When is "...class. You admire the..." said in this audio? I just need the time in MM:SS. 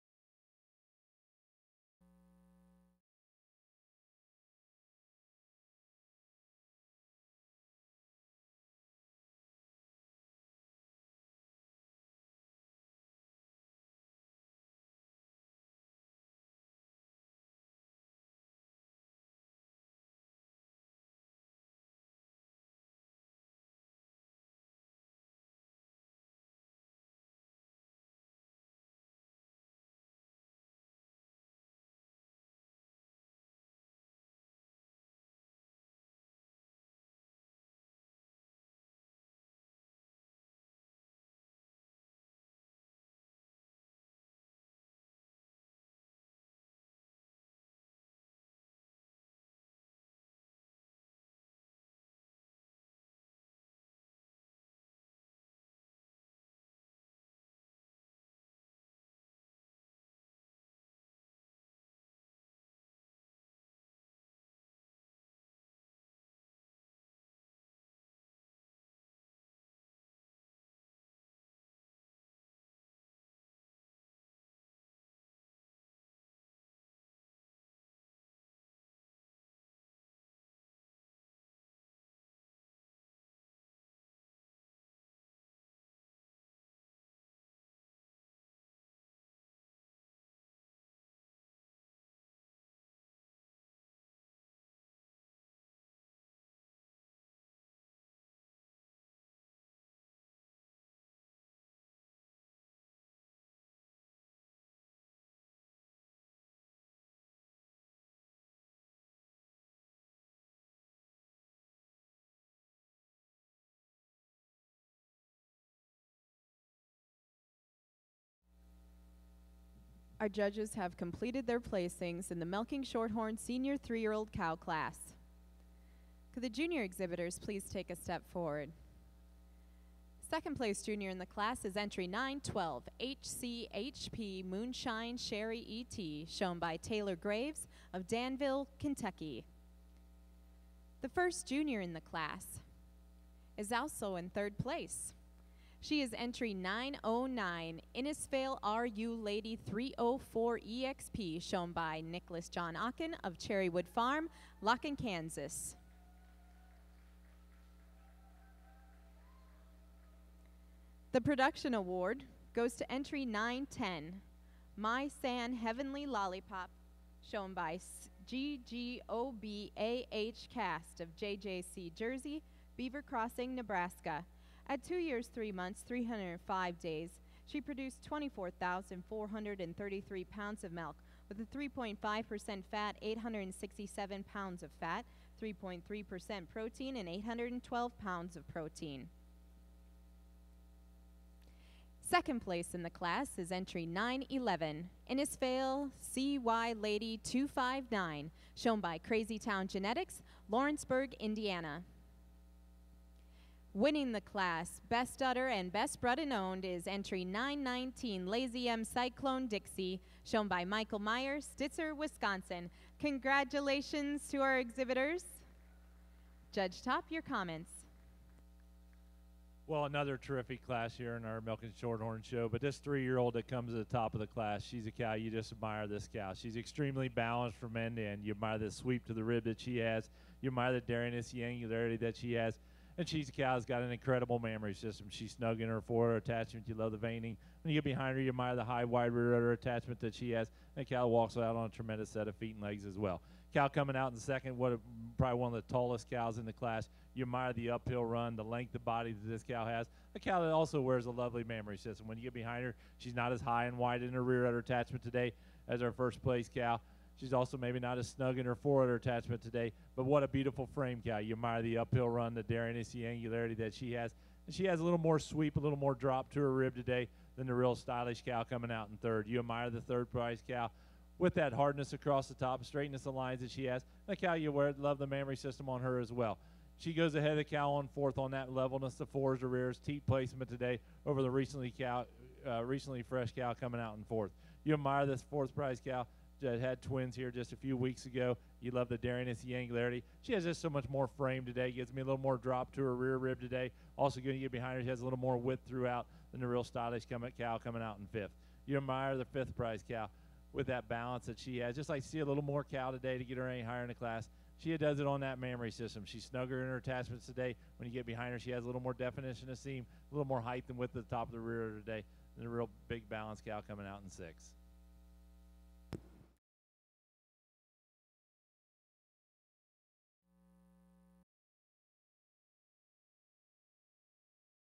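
04:06.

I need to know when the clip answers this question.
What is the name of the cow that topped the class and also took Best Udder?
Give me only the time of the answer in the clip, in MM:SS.
03:28.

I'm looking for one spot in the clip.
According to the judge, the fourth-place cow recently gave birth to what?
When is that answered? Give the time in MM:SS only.
04:46.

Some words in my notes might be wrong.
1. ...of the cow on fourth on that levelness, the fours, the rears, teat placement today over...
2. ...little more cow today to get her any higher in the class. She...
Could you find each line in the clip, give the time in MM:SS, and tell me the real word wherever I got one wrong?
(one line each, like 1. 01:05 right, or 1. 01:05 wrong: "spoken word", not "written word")
1. 04:37 right
2. 05:02 right.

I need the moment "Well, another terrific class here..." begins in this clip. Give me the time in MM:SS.
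03:39.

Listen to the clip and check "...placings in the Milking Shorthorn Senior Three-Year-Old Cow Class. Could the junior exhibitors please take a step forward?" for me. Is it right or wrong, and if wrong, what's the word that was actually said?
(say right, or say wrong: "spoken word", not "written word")
right.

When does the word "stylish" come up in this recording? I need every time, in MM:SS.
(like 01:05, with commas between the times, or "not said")
04:27, 04:56.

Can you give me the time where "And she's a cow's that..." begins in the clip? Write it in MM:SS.
03:53.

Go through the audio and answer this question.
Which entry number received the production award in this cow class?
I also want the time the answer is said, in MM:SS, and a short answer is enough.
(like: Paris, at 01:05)
910, at 02:43.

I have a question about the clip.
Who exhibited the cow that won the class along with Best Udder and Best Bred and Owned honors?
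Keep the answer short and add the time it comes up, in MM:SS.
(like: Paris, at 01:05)
Michael Meyer, at 03:30.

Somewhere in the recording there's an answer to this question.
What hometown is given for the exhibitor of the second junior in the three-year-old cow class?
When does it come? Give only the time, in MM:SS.
02:18.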